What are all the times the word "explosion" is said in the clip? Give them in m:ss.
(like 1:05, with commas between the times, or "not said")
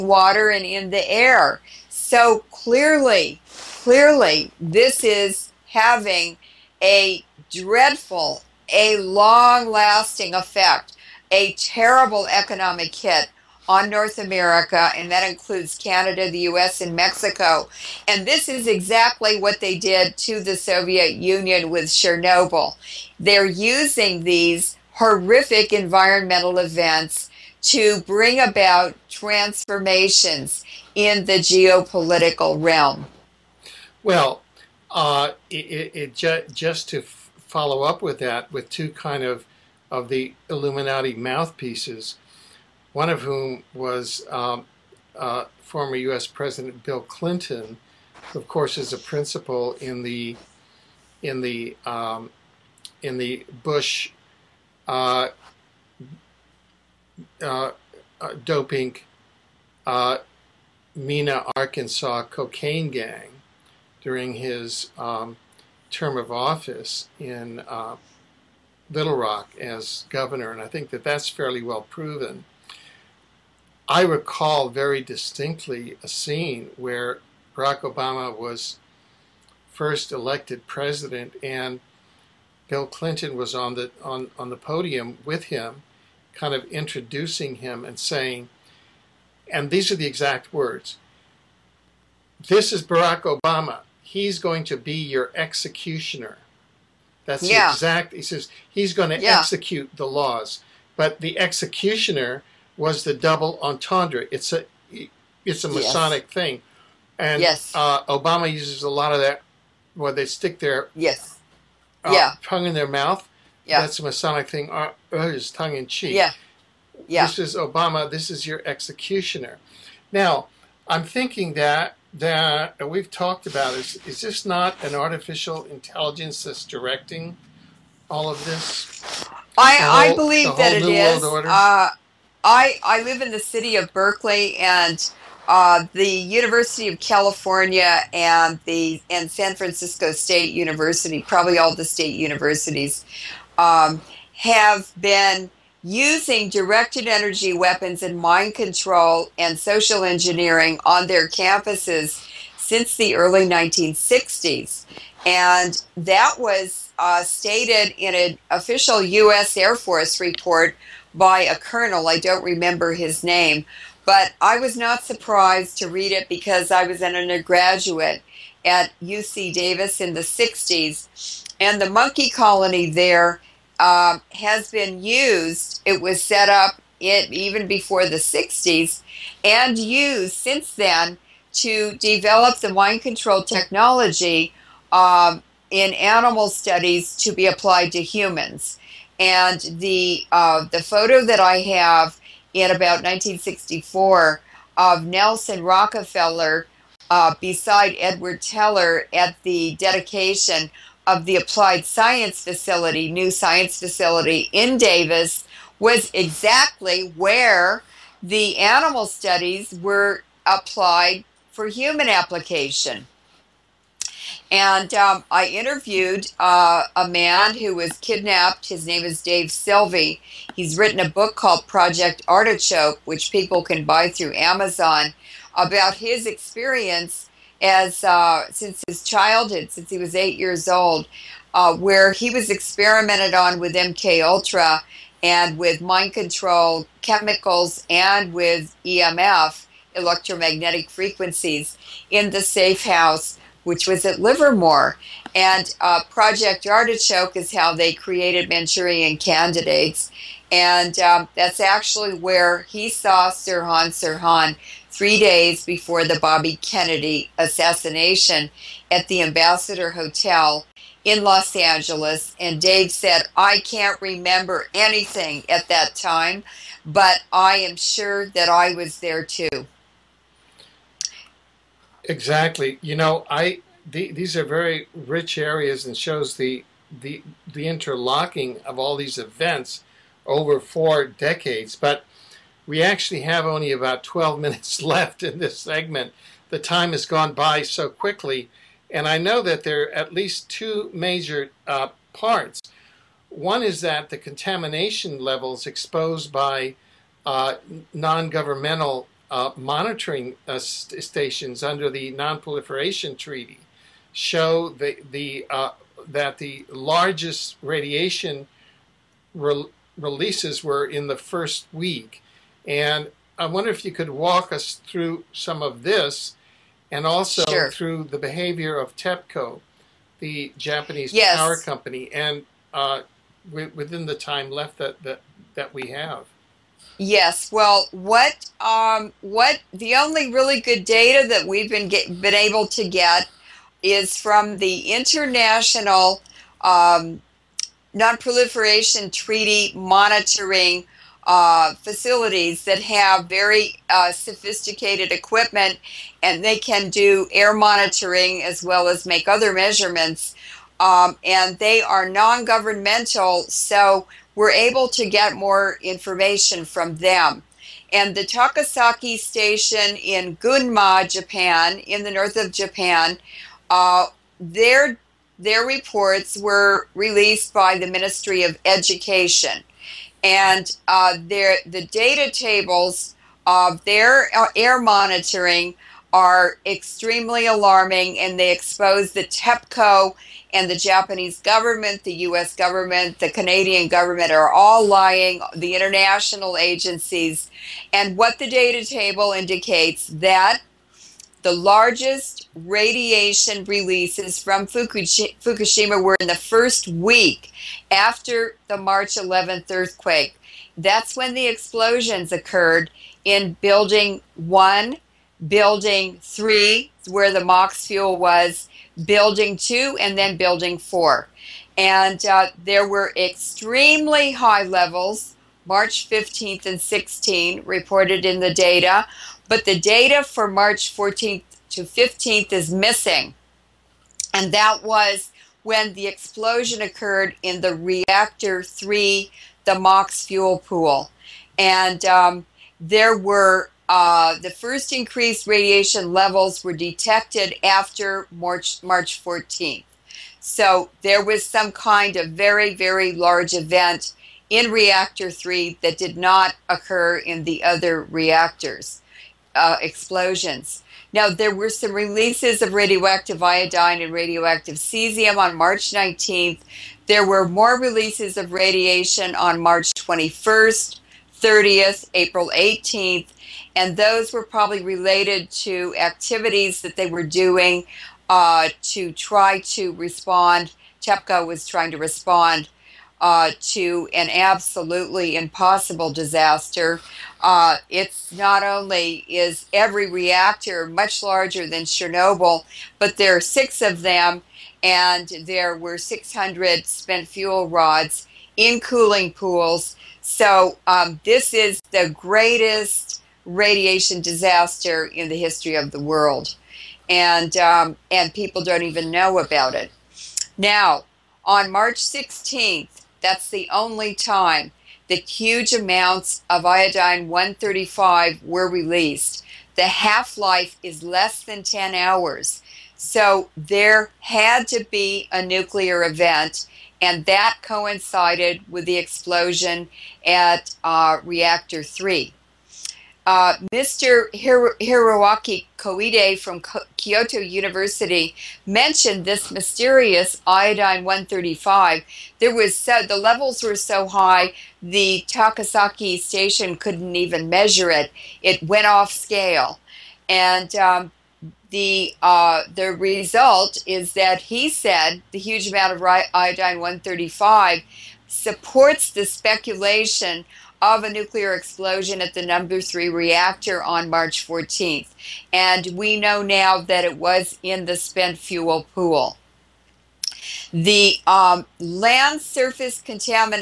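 6:41, 7:06, 7:29, 8:38, 9:11.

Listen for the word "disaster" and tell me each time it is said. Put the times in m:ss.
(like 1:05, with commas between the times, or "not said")
7:56, 8:14.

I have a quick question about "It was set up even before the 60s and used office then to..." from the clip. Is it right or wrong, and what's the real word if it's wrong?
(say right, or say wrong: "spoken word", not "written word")
wrong: "since", not "office".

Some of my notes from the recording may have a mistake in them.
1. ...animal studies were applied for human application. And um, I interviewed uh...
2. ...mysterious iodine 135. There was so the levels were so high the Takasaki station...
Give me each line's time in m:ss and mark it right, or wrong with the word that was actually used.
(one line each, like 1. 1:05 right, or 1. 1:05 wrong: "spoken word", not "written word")
1. 3:28 right
2. 8:49 right.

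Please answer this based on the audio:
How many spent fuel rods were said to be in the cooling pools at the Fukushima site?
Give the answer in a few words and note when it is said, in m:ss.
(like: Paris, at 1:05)
600, at 8:05.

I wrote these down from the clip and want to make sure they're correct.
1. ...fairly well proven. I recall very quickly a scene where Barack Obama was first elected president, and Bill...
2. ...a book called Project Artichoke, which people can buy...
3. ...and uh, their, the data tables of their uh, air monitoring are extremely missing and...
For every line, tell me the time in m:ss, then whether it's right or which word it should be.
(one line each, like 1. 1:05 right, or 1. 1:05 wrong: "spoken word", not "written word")
1. 1:11 wrong: "distinctly", not "quickly"
2. 3:40 right
3. 6:10 wrong: "alarming", not "missing".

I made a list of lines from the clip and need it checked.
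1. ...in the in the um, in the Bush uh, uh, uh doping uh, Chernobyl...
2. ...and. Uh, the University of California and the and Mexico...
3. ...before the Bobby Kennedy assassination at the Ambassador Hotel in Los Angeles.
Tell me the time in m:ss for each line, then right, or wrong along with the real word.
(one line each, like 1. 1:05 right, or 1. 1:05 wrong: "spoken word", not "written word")
1. 0:49 wrong: "Mena", not "Chernobyl"
2. 2:14 wrong: "San", not "Mexico"
3. 4:15 right.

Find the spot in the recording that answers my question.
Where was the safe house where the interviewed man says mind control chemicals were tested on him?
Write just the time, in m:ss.
4:04.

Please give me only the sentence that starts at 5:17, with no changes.
through the behavior of TEPCO, the Japanese yes.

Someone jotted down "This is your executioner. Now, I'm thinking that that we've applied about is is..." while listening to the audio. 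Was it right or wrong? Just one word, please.
wrong.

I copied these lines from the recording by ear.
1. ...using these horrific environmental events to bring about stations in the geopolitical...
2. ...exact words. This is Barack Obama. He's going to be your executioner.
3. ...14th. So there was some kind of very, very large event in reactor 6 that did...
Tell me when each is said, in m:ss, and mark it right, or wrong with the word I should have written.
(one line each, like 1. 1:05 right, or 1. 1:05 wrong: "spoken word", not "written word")
1. 0:23 wrong: "transformations", not "stations"
2. 1:30 right
3. 7:19 wrong: "3", not "6".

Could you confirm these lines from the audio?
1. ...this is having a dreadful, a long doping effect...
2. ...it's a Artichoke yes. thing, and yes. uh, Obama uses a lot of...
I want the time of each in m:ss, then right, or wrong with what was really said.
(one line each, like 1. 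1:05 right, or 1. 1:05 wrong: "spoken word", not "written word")
1. 0:04 wrong: "lasting", not "doping"
2. 1:45 wrong: "Masonic", not "Artichoke".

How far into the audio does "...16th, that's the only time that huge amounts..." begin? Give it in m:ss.
8:21.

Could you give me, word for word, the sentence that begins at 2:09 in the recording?
I whole, I believe that it is.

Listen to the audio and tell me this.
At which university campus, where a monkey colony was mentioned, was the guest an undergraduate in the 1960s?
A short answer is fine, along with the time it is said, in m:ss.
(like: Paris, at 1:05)
UC Davis, at 2:49.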